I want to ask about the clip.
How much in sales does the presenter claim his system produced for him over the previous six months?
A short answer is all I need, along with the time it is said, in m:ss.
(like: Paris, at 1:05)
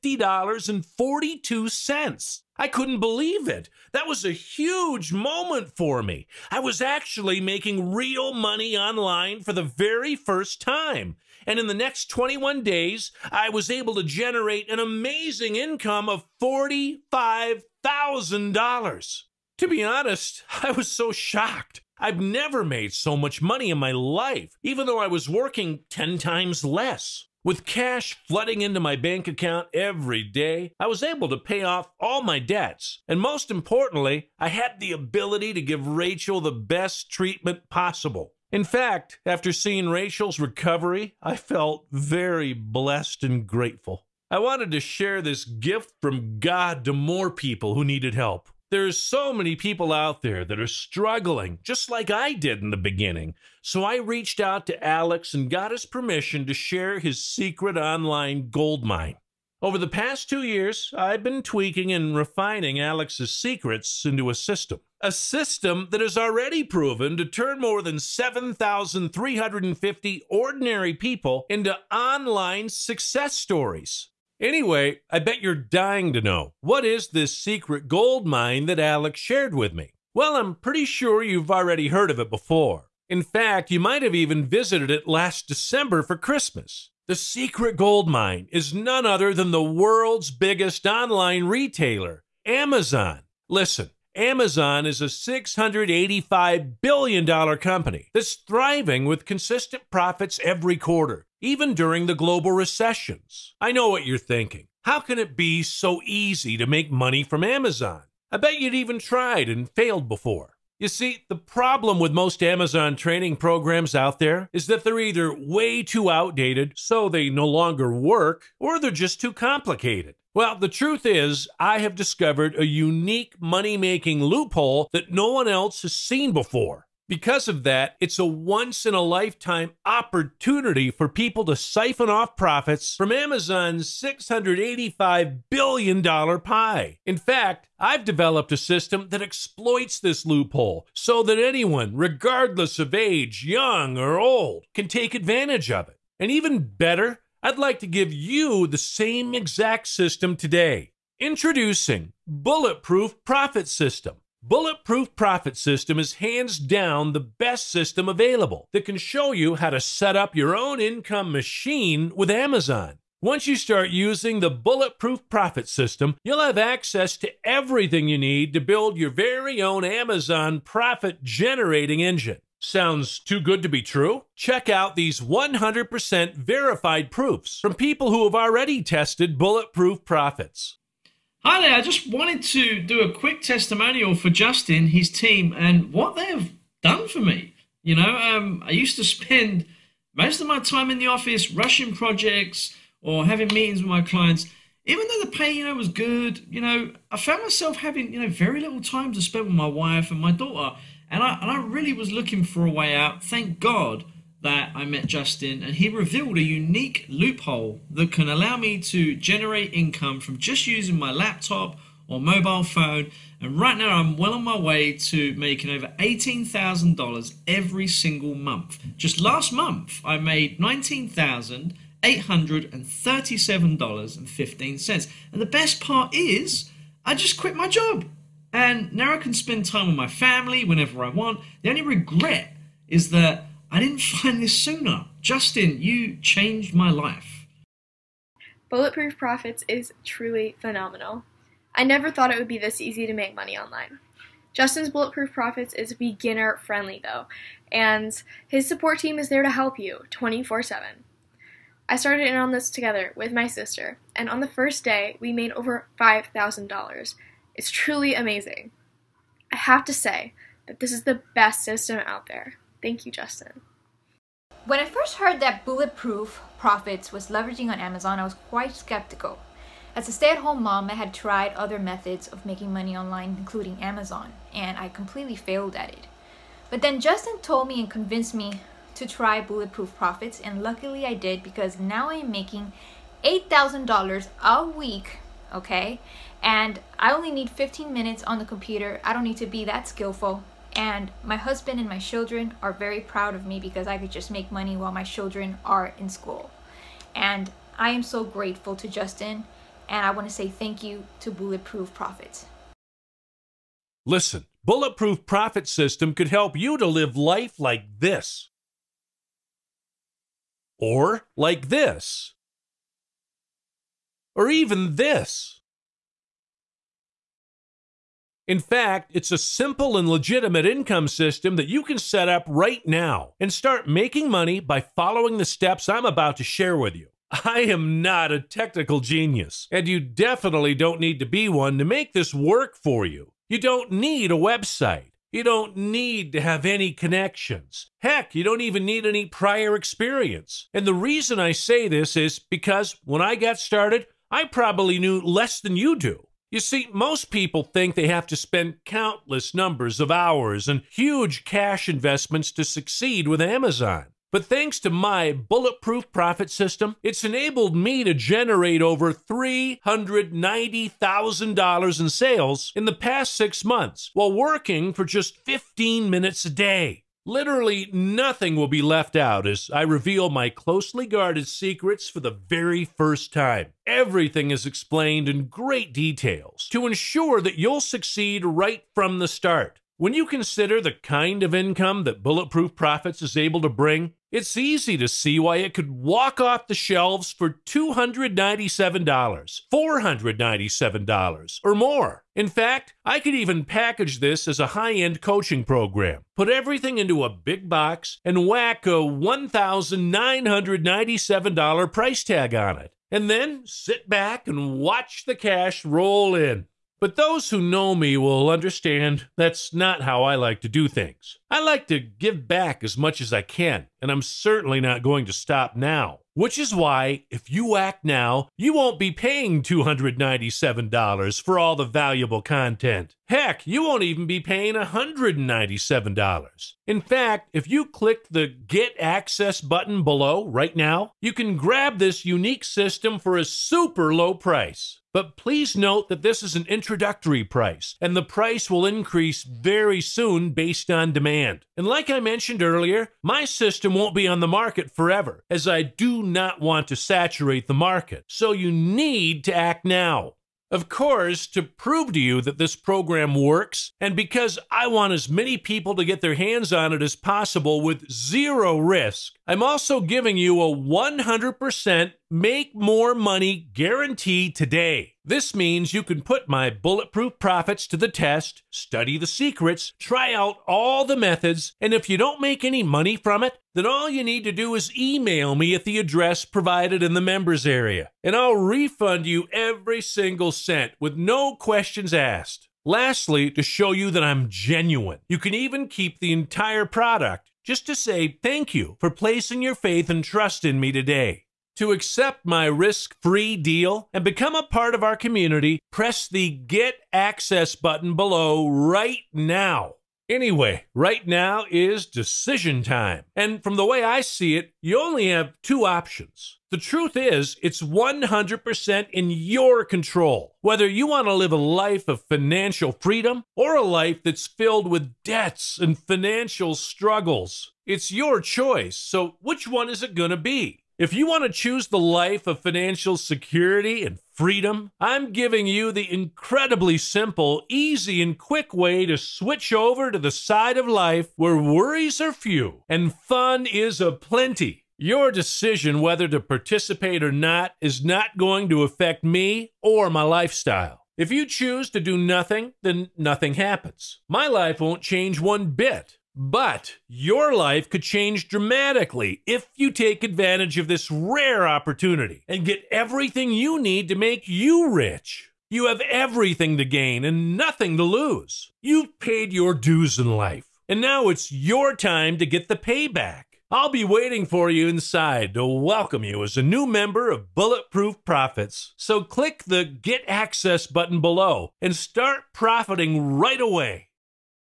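$390,000, at 5:59.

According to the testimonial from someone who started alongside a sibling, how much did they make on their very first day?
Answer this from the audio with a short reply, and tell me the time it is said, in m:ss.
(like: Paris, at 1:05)
$5,000, at 4:15.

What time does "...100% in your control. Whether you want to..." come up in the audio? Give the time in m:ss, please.
8:27.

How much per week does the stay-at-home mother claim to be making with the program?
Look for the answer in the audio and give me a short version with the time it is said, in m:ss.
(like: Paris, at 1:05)
$8,000, at 4:43.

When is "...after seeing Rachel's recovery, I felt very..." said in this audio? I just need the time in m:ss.
0:39.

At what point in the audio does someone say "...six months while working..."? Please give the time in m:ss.
6:03.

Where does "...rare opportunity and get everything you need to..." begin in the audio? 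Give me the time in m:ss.
9:11.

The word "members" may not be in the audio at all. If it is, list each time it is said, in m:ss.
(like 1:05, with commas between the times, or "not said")
7:57, 9:26.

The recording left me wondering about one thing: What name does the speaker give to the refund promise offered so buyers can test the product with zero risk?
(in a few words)
make more money guarantee.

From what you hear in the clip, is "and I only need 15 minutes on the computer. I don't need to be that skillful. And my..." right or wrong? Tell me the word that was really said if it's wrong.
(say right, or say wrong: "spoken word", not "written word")
right.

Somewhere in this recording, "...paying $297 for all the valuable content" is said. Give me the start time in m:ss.
6:59.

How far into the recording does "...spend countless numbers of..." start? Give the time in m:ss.
5:48.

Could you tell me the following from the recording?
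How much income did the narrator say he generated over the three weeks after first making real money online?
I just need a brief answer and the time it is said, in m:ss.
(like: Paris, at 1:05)
$45,000, at 0:16.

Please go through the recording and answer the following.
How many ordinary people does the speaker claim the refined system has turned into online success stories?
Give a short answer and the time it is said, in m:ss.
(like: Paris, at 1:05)
7,350, at 1:07.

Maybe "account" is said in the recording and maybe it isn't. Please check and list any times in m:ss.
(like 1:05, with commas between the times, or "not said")
0:29.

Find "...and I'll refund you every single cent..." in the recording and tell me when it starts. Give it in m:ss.
7:58.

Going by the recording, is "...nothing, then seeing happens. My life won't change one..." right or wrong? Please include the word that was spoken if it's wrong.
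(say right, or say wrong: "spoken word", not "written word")
wrong: "nothing", not "seeing".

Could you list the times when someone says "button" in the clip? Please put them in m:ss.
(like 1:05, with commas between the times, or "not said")
7:09, 8:17, 9:30.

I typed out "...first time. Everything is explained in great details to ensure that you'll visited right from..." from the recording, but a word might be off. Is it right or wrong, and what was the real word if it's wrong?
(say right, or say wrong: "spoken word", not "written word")
wrong: "succeed", not "visited".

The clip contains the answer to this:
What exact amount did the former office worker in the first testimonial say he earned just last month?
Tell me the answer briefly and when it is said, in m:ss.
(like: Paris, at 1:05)
$19,837.15, at 3:40.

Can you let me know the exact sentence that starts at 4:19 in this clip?
I have to say that this is the best system out there.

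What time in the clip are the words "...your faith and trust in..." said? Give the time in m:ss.
8:09.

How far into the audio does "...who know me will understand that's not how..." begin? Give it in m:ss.
6:47.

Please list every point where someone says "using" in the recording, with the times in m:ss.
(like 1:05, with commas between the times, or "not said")
2:43, 3:30.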